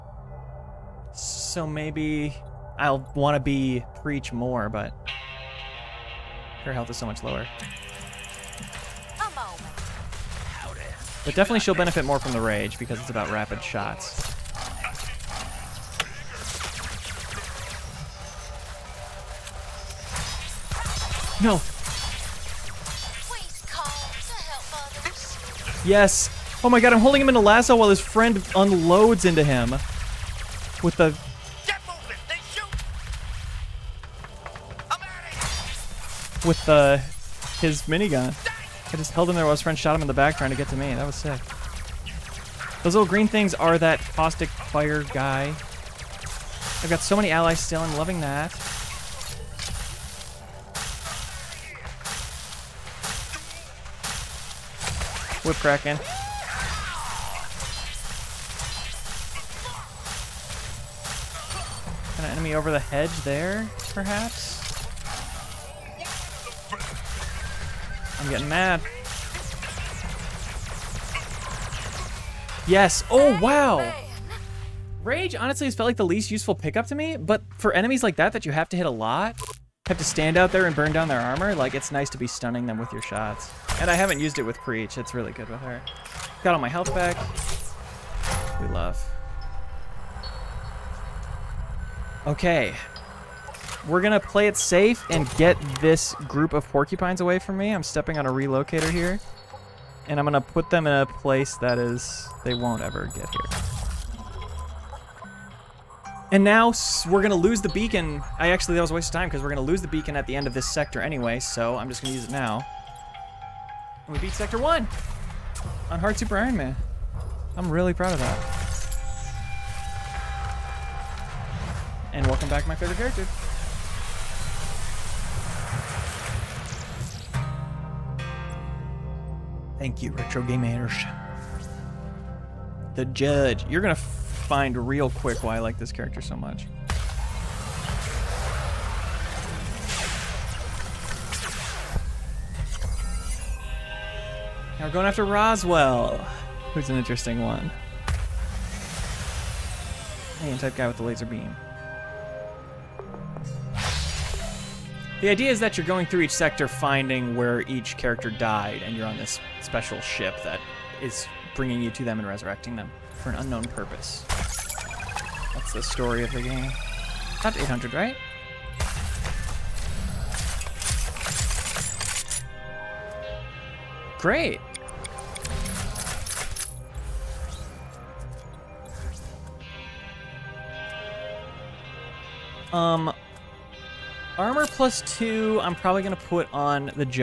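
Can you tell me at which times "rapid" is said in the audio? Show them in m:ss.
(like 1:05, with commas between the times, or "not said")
0:13.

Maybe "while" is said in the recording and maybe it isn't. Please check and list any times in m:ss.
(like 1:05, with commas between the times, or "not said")
0:27, 0:39.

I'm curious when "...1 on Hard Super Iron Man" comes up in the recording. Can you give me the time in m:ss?
1:54.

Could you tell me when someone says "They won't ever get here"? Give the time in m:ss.
1:42.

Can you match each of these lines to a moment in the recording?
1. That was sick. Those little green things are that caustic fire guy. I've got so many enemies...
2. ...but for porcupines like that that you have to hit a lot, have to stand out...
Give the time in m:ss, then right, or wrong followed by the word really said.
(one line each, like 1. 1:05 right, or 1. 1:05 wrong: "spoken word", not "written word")
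1. 0:40 wrong: "allies", not "enemies"
2. 1:17 wrong: "enemies", not "porcupines".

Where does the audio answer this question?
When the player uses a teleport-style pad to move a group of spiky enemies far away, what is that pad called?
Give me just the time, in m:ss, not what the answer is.
1:38.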